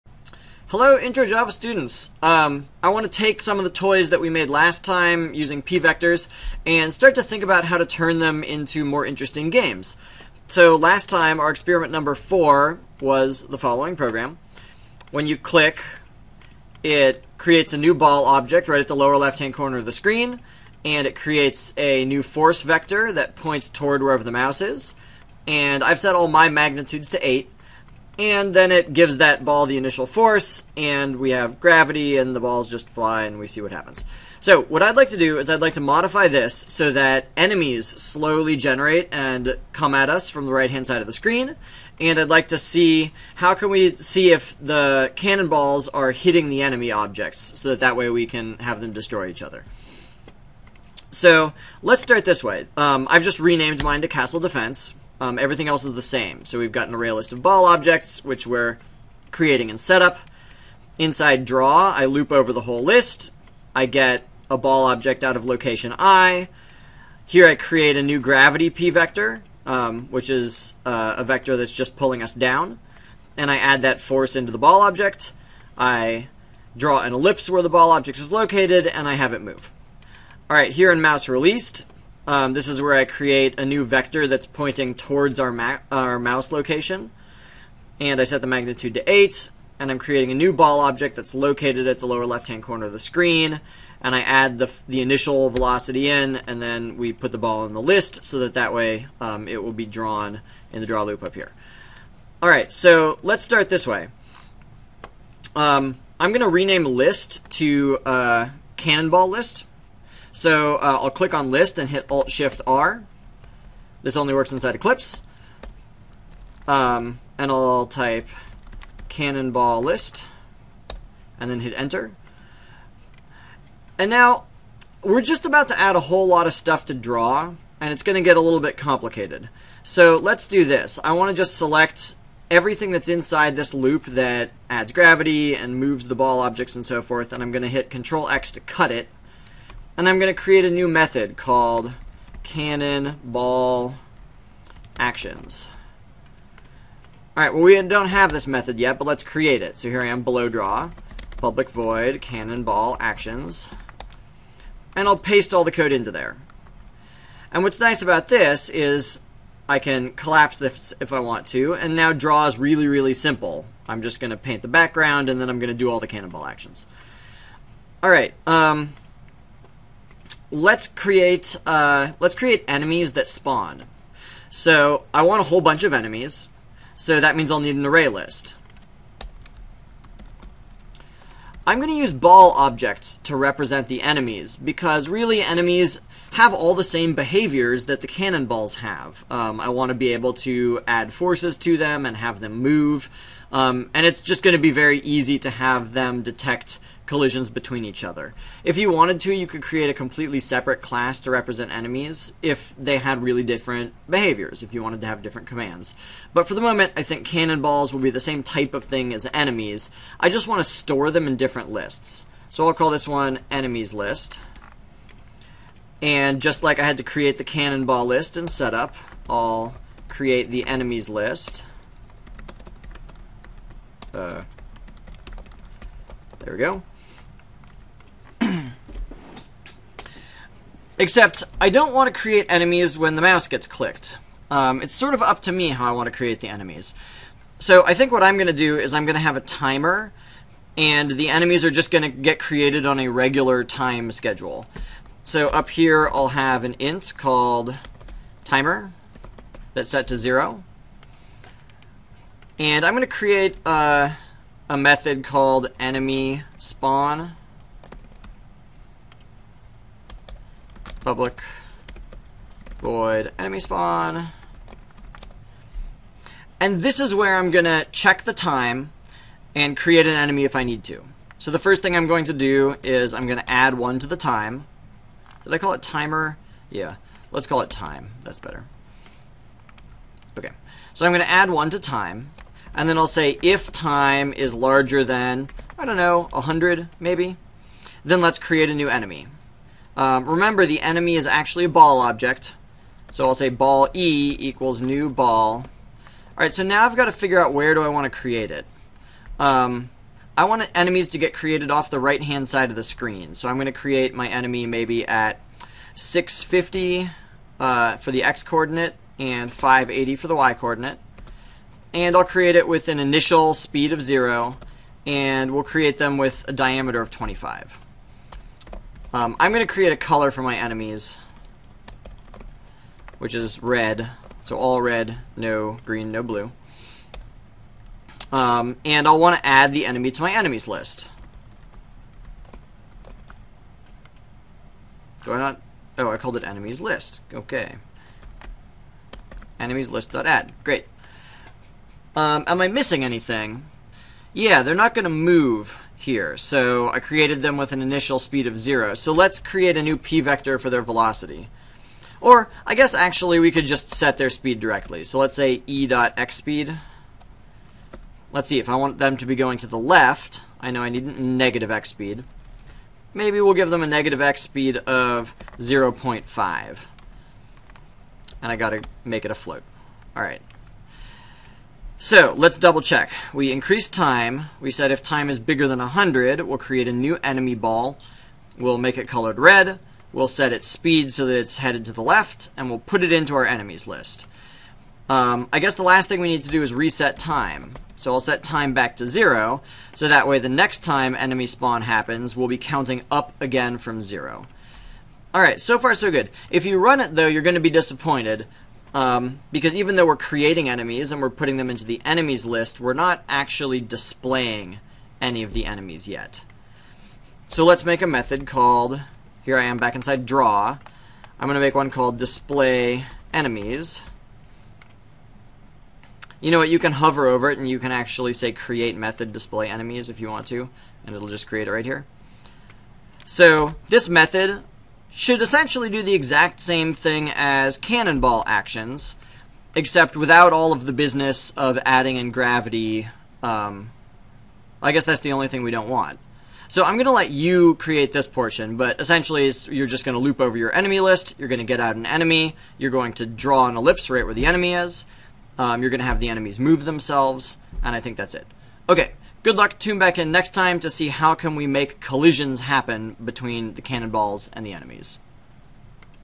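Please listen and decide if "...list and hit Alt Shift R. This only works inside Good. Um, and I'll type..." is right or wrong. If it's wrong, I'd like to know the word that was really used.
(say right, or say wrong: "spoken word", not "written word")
wrong: "Eclipse", not "Good".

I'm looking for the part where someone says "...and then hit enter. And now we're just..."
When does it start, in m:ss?
2:01.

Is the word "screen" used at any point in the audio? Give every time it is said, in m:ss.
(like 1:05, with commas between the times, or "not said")
0:19, 0:41, 1:32, 5:02.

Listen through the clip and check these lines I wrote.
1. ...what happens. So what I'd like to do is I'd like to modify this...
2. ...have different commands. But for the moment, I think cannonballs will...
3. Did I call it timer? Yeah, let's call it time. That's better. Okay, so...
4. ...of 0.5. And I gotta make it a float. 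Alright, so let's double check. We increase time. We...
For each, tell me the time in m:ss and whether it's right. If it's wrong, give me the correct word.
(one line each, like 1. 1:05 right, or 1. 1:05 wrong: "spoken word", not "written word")
1. 0:33 right
2. 3:25 right
3. 4:35 right
4. 6:04 right.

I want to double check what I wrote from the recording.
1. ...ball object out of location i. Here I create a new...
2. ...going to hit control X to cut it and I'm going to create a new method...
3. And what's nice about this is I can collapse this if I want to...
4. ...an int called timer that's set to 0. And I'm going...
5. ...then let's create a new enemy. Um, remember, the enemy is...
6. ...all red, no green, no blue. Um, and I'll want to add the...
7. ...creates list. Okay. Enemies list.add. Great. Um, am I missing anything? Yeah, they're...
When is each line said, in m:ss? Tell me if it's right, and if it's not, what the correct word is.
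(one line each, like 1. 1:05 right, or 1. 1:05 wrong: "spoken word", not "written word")
1. 1:04 right
2. 2:17 right
3. 2:37 right
4. 4:06 right
5. 4:48 right
6. 5:24 right
7. 5:36 wrong: "enemies", not "creates".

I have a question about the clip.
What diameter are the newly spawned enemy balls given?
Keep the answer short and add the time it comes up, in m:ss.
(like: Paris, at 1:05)
25, at 5:17.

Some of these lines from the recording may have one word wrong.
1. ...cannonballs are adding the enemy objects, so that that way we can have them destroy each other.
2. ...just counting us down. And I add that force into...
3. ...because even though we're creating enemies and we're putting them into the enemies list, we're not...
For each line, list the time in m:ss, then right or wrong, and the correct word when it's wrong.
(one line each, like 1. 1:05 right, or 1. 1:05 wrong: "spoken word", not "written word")
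1. 0:45 wrong: "hitting", not "adding"
2. 1:11 wrong: "pulling", not "counting"
3. 6:39 right.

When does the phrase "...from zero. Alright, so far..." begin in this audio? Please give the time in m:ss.
6:33.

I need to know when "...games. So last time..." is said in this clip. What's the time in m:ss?
0:09.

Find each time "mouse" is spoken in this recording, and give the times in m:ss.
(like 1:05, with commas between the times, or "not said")
0:24, 1:20, 1:26, 3:53.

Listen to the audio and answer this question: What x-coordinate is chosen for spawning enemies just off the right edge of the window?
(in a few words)
650.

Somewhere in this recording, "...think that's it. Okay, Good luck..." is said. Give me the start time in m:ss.
7:27.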